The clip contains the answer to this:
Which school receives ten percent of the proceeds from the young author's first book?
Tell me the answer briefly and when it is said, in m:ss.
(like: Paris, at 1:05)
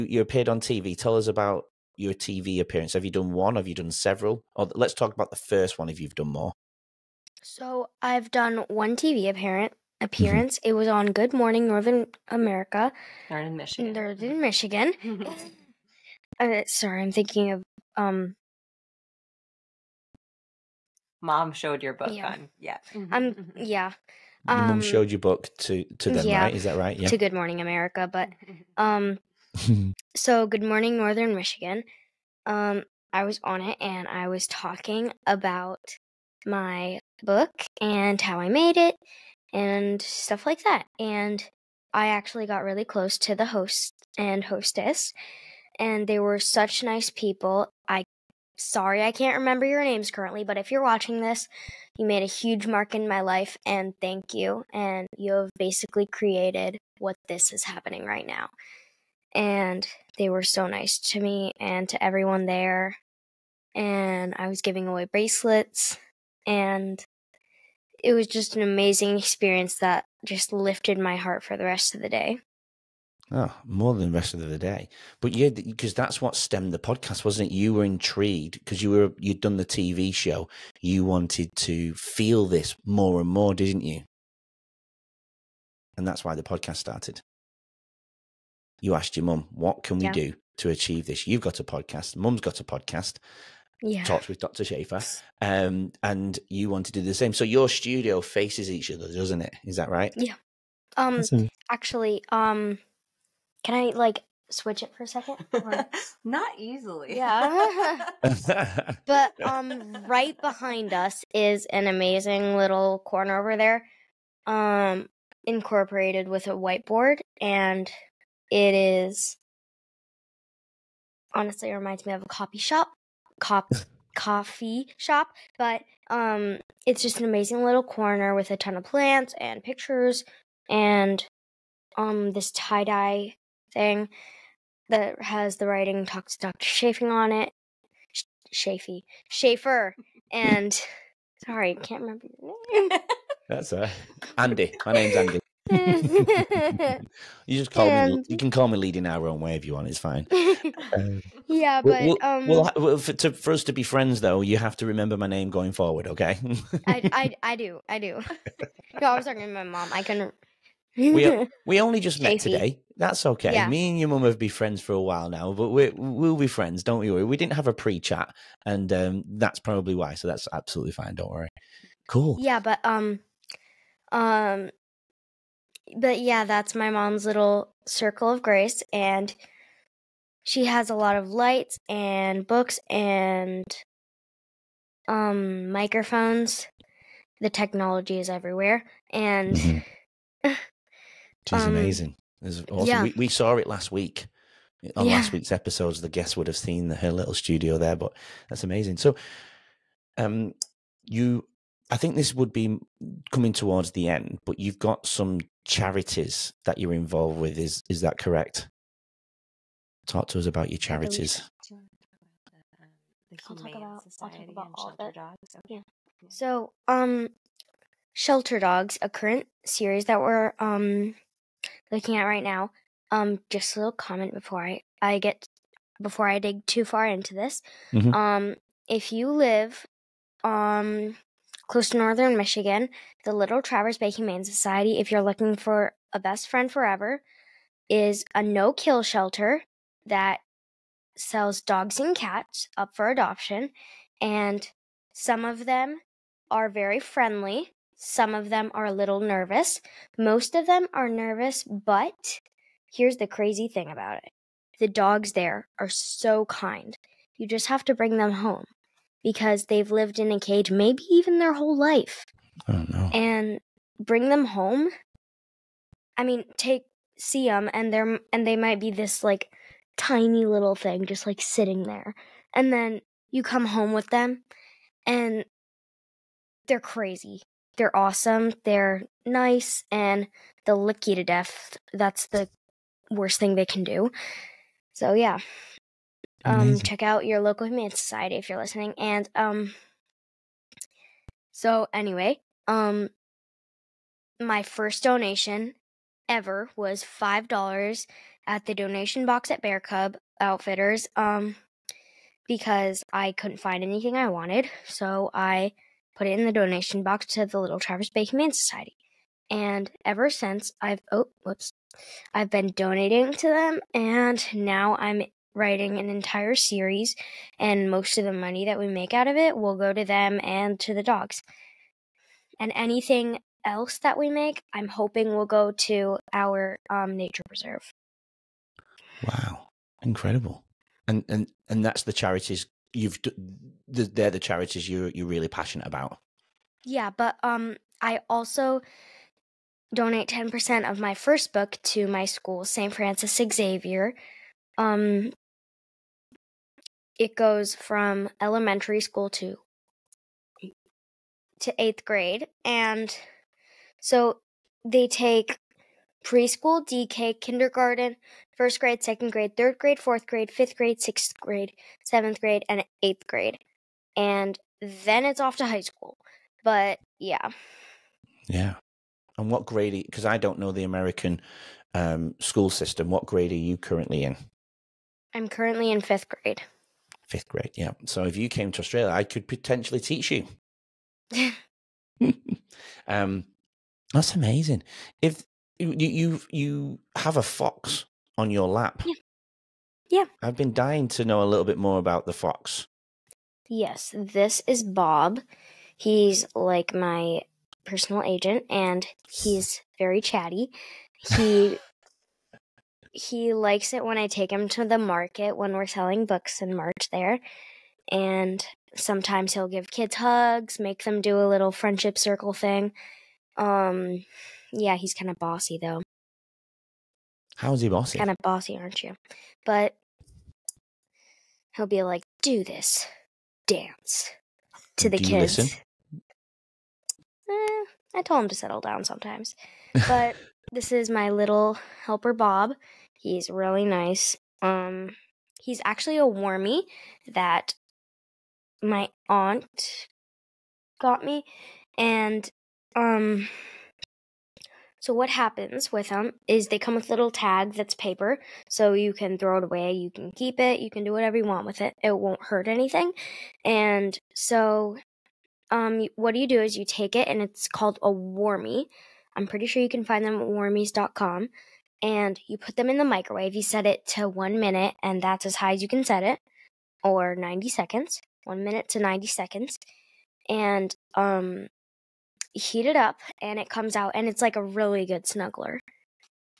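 St. Francis Xavier, at 5:42.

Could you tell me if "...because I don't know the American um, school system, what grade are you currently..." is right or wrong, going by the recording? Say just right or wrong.
right.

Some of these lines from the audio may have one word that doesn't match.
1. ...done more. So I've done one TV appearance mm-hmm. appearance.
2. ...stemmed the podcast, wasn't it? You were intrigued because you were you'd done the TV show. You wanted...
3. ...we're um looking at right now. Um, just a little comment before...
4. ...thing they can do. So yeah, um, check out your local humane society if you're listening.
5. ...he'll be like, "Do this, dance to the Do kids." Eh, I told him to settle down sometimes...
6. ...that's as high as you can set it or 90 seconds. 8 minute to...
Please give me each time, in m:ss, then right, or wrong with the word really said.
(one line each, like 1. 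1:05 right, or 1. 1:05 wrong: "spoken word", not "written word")
1. 0:06 right
2. 1:16 right
3. 3:40 right
4. 4:43 right
5. 7:01 right
6. 7:45 wrong: "1", not "8".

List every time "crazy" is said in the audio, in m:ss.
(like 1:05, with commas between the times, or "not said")
4:13, 4:36.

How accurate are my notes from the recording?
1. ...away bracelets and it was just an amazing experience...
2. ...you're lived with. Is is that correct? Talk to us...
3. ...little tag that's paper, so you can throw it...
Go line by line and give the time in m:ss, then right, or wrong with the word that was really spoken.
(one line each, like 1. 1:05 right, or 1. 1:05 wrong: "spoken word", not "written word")
1. 1:04 right
2. 3:26 wrong: "involved", not "lived"
3. 7:27 right.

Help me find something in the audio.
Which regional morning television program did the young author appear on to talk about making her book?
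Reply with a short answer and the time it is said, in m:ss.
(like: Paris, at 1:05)
Good Morning Northern Michigan, at 0:30.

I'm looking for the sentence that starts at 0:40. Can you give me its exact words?
And I actually got really close to the host and hostess and they were such nice people.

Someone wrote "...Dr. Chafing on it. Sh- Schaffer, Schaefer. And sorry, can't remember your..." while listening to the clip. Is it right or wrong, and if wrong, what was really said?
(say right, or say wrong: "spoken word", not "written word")
right.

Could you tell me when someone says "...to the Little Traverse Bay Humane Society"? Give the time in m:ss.
5:07.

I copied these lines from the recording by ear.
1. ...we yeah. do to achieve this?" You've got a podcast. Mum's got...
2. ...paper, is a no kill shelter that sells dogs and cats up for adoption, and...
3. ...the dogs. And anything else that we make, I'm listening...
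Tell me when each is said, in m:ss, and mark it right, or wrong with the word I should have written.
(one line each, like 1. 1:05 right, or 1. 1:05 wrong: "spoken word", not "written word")
1. 1:29 right
2. 3:56 wrong: "forever", not "paper"
3. 5:20 wrong: "hoping", not "listening".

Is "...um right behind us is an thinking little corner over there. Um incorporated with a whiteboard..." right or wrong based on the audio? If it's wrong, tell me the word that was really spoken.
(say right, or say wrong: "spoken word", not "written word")
wrong: "amazing", not "thinking".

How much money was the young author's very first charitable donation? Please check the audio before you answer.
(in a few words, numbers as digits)
$5.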